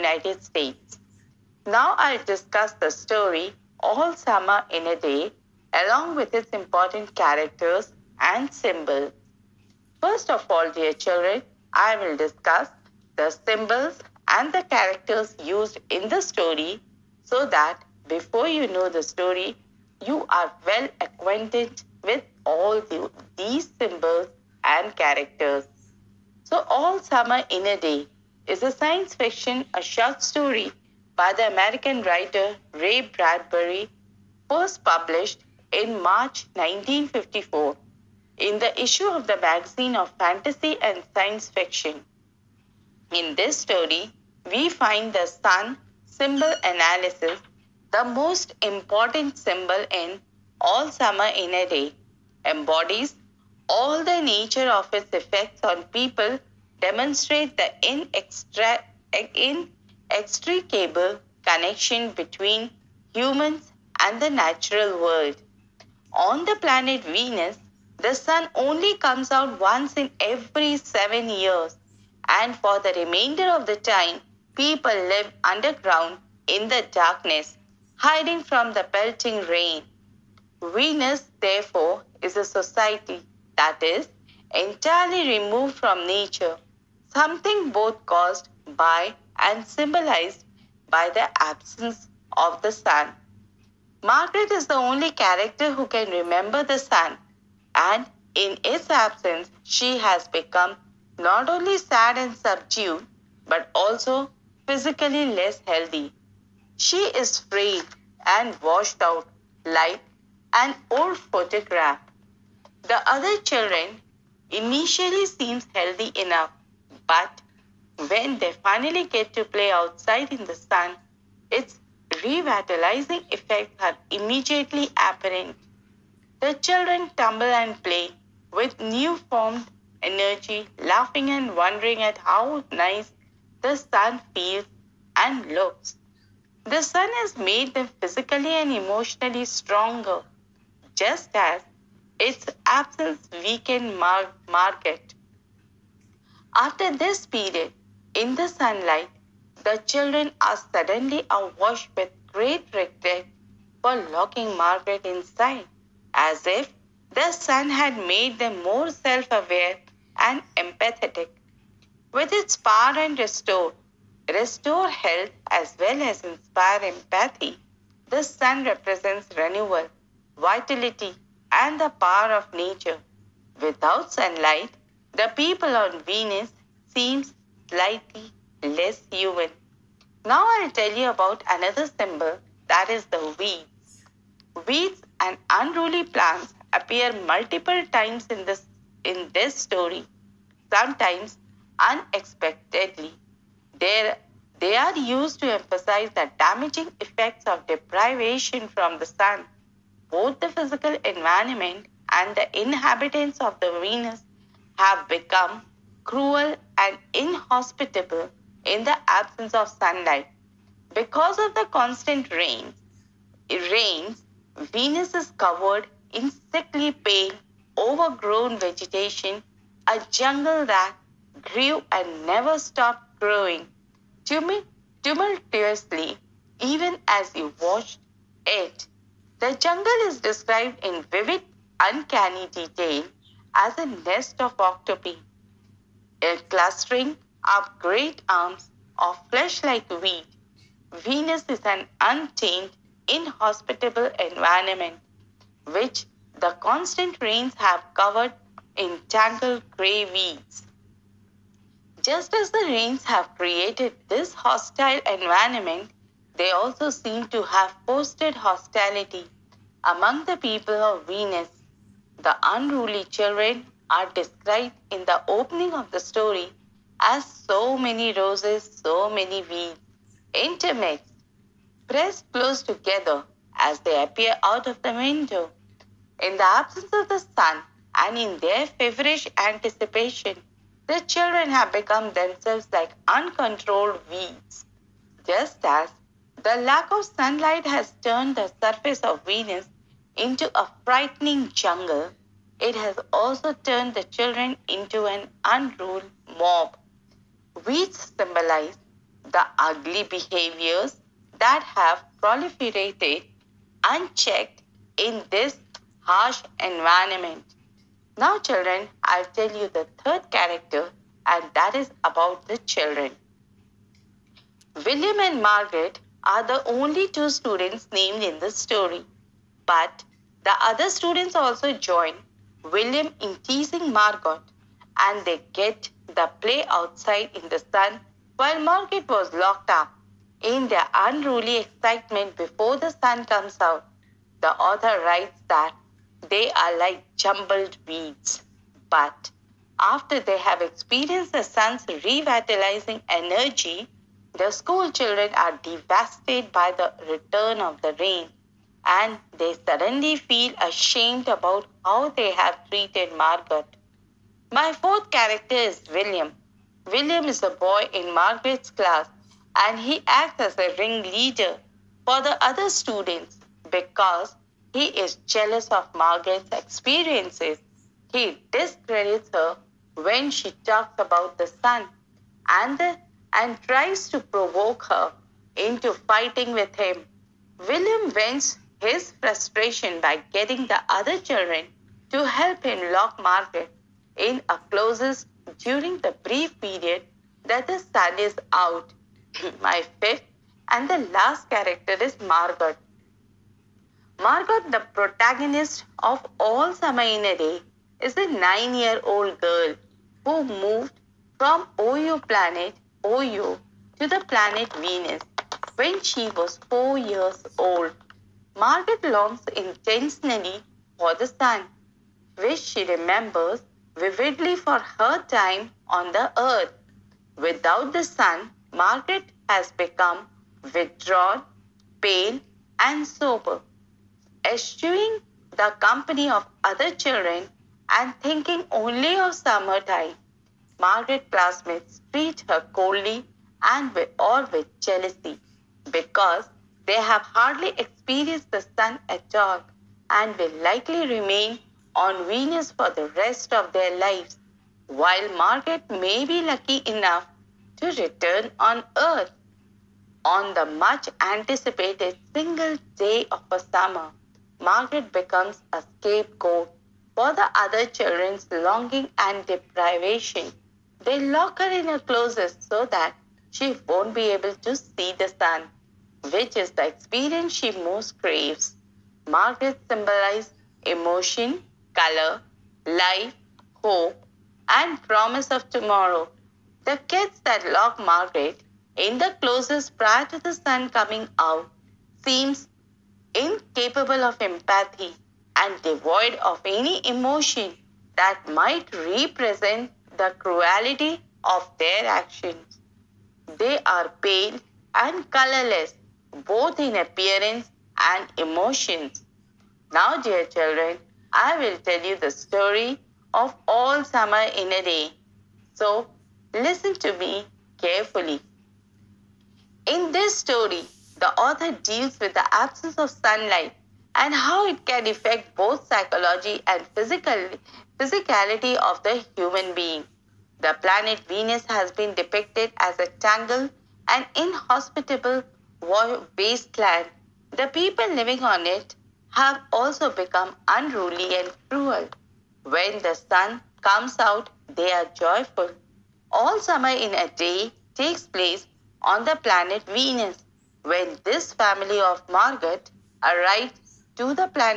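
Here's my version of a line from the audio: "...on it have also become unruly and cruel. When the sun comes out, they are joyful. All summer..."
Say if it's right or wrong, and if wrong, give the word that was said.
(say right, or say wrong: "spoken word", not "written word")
right.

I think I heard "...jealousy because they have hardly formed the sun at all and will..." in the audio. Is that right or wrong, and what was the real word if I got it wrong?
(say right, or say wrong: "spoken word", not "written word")
wrong: "experienced", not "formed".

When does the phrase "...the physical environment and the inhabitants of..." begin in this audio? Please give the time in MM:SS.
03:20.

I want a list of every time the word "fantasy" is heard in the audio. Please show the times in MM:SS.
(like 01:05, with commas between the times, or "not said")
00:40.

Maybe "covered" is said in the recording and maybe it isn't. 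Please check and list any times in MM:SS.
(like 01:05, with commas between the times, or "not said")
03:35, 04:07.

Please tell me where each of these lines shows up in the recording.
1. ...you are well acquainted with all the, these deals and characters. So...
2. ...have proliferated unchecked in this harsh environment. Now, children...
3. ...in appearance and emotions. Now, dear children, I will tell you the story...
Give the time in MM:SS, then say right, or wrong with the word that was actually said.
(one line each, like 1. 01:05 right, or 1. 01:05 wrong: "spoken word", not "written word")
1. 00:20 wrong: "symbols", not "deals"
2. 05:01 right
3. 08:16 right.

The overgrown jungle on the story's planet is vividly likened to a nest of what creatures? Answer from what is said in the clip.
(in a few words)
Octopi.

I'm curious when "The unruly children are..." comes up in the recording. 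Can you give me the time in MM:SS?
04:22.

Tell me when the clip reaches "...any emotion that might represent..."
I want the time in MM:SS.
08:06.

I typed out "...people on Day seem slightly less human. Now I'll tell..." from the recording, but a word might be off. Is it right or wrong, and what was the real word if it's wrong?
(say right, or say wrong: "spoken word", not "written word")
wrong: "Venus", not "Day".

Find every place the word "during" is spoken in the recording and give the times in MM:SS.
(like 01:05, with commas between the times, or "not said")
06:25.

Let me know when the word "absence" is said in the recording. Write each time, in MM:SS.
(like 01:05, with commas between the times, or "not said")
01:31, 01:38, 02:22, 03:29, 04:36, 08:32.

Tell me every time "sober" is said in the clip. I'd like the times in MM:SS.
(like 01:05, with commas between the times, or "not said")
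07:03.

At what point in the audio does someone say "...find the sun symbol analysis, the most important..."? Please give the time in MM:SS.
00:44.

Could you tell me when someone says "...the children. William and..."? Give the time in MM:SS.
05:12.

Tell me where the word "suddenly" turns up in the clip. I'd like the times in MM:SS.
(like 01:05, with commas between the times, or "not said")
02:30, 05:49.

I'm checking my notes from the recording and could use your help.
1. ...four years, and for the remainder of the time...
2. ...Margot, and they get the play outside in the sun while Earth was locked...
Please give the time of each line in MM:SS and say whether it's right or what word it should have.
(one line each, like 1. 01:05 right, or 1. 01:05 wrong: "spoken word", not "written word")
1. 01:10 wrong: "seven", not "four"
2. 05:23 wrong: "Margaret", not "Earth".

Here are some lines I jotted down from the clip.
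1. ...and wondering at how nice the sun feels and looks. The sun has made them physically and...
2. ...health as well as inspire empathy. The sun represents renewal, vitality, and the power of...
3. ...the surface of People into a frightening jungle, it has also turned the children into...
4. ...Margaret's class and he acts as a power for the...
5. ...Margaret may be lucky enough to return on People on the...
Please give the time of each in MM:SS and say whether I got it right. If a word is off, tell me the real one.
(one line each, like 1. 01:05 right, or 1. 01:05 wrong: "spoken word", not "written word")
1. 02:11 right
2. 02:44 right
3. 04:48 wrong: "Venus", not "People"
4. 05:58 wrong: "ringleader", not "power"
5. 07:25 wrong: "Earth", not "People".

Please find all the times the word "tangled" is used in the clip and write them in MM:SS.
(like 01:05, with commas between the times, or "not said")
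04:09, 08:43.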